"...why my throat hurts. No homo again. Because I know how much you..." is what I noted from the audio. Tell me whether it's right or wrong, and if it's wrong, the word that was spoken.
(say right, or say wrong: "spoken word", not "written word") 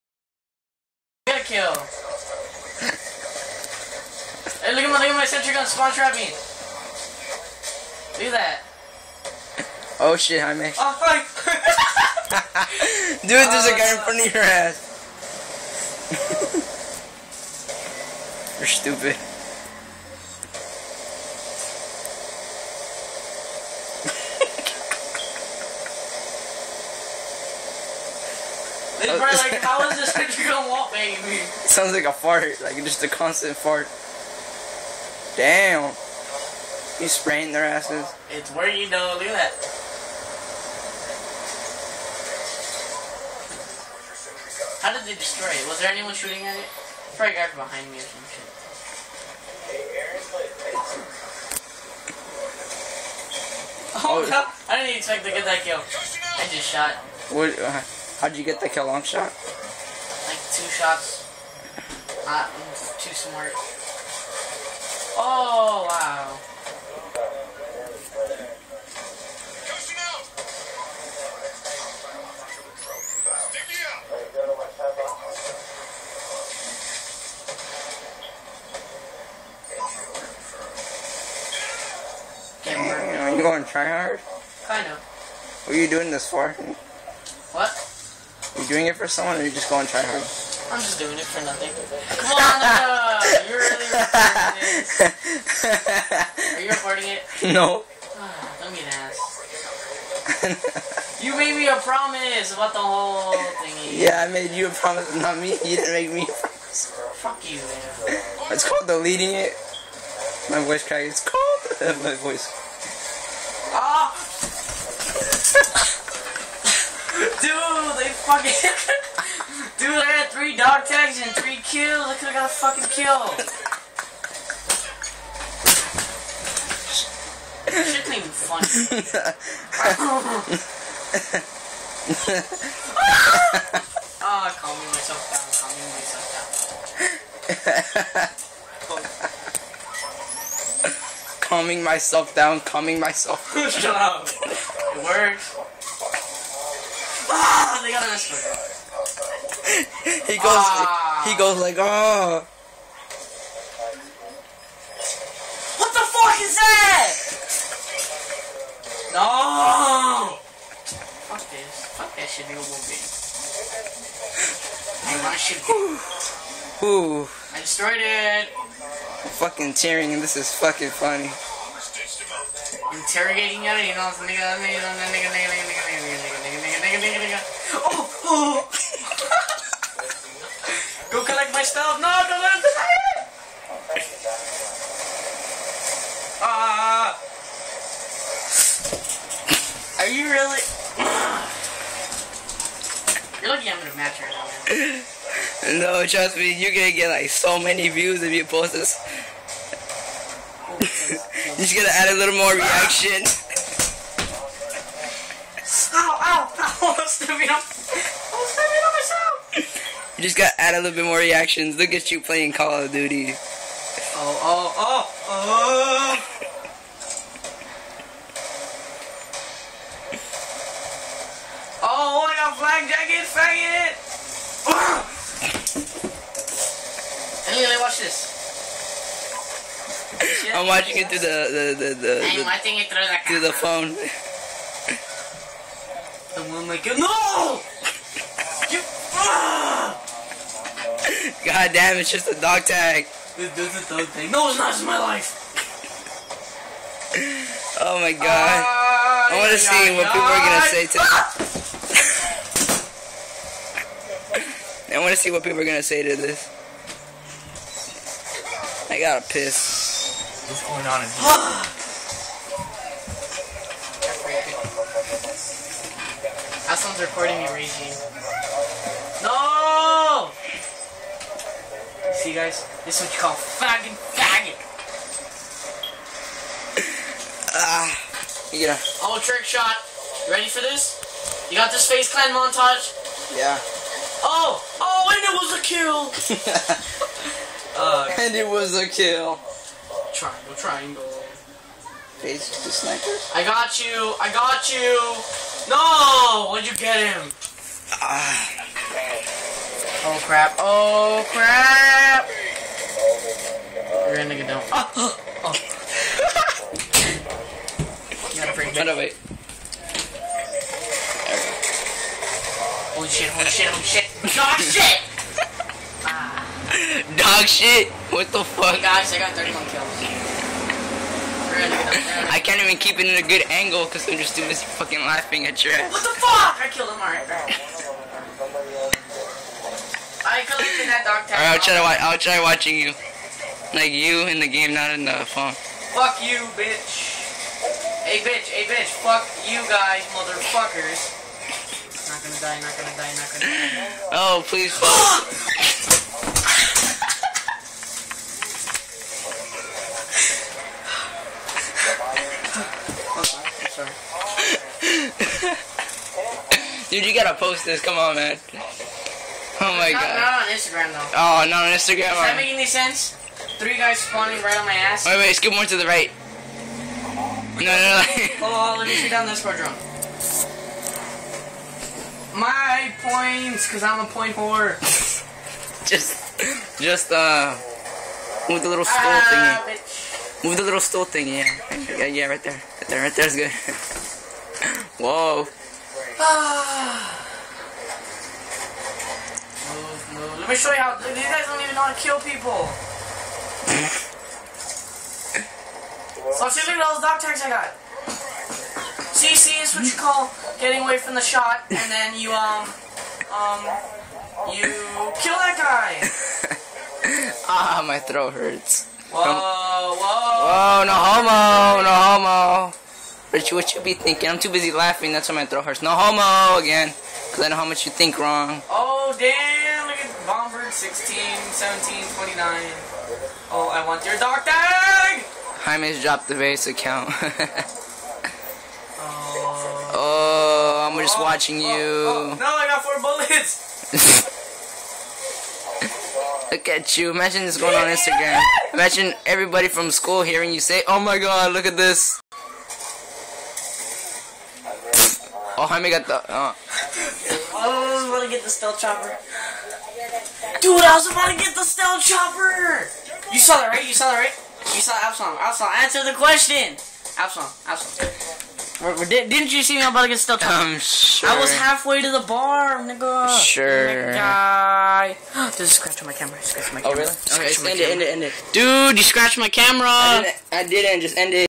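right.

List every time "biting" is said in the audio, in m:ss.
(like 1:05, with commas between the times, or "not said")
not said.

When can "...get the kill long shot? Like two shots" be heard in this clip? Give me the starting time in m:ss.
0:58.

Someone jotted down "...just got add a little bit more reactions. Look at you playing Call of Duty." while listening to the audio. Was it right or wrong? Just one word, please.
right.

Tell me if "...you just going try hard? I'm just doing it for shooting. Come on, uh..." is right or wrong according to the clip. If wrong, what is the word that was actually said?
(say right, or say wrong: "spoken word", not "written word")
wrong: "nothing", not "shooting".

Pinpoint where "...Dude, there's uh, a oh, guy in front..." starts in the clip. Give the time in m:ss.
0:13.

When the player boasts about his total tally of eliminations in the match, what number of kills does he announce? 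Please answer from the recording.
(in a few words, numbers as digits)
31.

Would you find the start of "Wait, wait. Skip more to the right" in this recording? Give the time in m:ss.
6:05.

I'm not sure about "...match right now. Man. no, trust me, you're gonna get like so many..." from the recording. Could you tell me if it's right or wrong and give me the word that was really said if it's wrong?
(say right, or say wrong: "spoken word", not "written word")
right.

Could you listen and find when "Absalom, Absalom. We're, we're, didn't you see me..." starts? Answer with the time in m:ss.
7:37.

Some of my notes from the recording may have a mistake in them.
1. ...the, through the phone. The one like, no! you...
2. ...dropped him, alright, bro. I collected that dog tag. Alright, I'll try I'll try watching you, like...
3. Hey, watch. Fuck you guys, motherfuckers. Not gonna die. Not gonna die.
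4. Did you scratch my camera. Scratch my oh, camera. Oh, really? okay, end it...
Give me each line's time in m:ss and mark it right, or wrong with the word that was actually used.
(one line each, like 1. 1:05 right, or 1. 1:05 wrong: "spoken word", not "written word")
1. 3:52 right
2. 5:26 wrong: "killed", not "dropped"
3. 5:38 wrong: "bitch", not "watch"
4. 7:45 right.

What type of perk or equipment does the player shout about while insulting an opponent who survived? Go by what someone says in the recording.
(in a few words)
flak jacket.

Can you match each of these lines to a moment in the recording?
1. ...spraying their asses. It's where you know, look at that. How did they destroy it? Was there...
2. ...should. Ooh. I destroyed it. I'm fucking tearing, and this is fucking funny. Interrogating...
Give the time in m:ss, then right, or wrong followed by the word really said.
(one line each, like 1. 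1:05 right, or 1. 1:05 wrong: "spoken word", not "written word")
1. 0:37 right
2. 2:45 right.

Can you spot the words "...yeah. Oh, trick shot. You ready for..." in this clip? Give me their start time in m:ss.
4:38.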